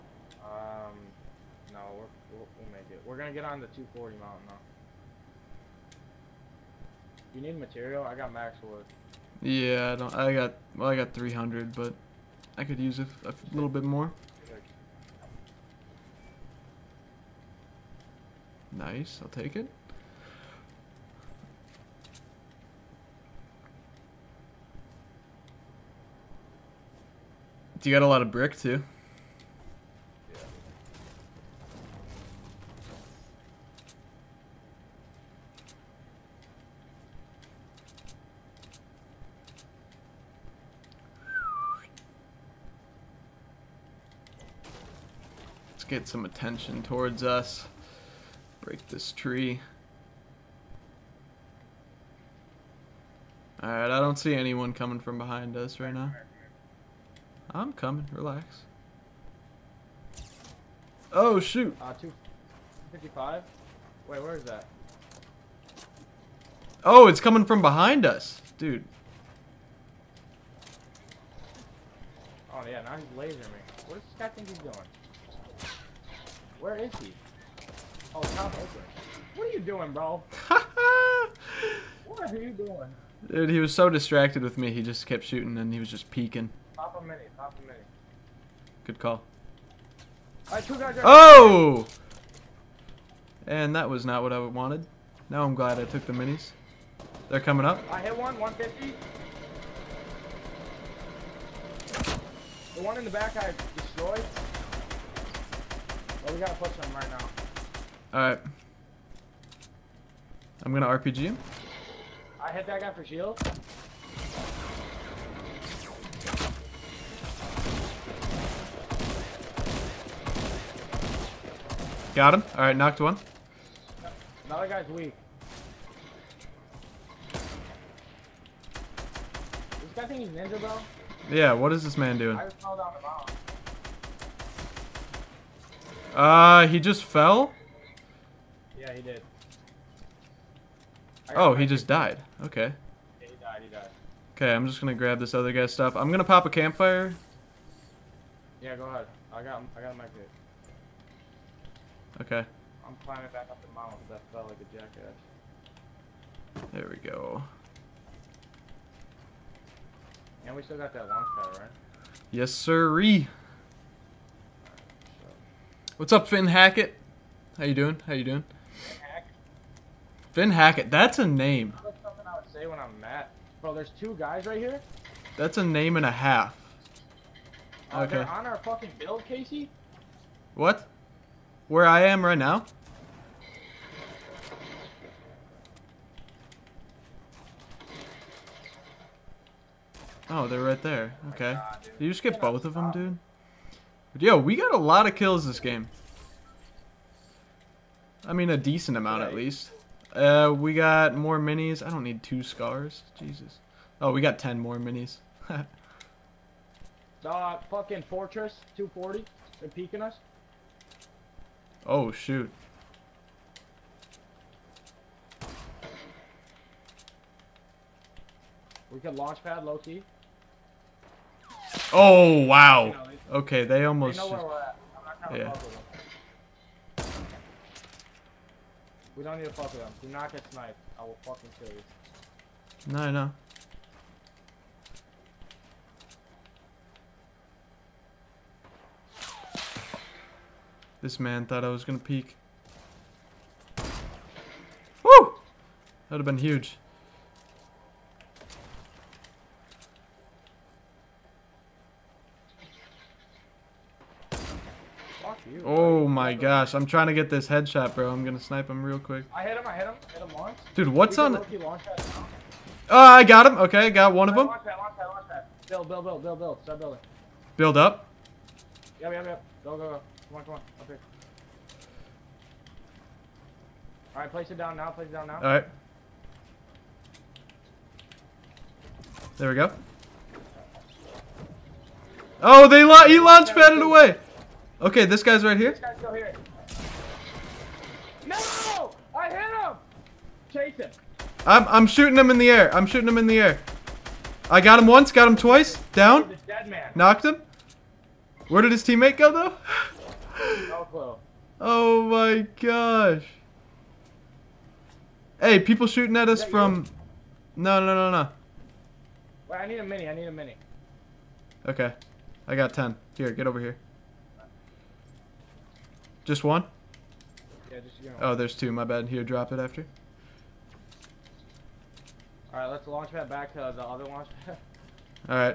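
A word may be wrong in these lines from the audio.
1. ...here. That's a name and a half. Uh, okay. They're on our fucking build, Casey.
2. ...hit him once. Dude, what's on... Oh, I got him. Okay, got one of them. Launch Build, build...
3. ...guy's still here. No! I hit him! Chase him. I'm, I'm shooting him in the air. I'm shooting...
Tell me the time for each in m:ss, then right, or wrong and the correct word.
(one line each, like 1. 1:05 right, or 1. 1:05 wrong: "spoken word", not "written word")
1. 2:54 right
2. 4:20 right
3. 4:45 right.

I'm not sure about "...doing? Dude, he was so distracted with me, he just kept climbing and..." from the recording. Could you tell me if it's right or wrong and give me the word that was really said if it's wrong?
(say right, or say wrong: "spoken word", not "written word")
wrong: "shooting", not "climbing".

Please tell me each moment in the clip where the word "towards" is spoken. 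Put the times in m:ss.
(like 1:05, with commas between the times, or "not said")
0:46.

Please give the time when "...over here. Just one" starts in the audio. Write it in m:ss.
5:13.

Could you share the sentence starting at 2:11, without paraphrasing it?
Yeah, what is this man doing?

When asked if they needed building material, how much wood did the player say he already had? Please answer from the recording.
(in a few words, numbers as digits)
300.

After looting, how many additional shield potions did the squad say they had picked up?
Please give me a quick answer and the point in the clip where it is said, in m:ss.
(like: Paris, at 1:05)
10, at 3:24.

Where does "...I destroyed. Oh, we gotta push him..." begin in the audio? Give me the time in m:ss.
1:43.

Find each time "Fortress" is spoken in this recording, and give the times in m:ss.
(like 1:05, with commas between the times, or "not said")
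3:28.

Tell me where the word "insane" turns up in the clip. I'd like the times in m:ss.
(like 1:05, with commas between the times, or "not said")
not said.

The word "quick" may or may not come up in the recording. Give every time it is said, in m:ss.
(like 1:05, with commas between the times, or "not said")
4:18.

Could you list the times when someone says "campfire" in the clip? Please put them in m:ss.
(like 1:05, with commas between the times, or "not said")
2:26.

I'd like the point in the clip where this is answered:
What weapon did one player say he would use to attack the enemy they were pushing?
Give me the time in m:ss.
1:50.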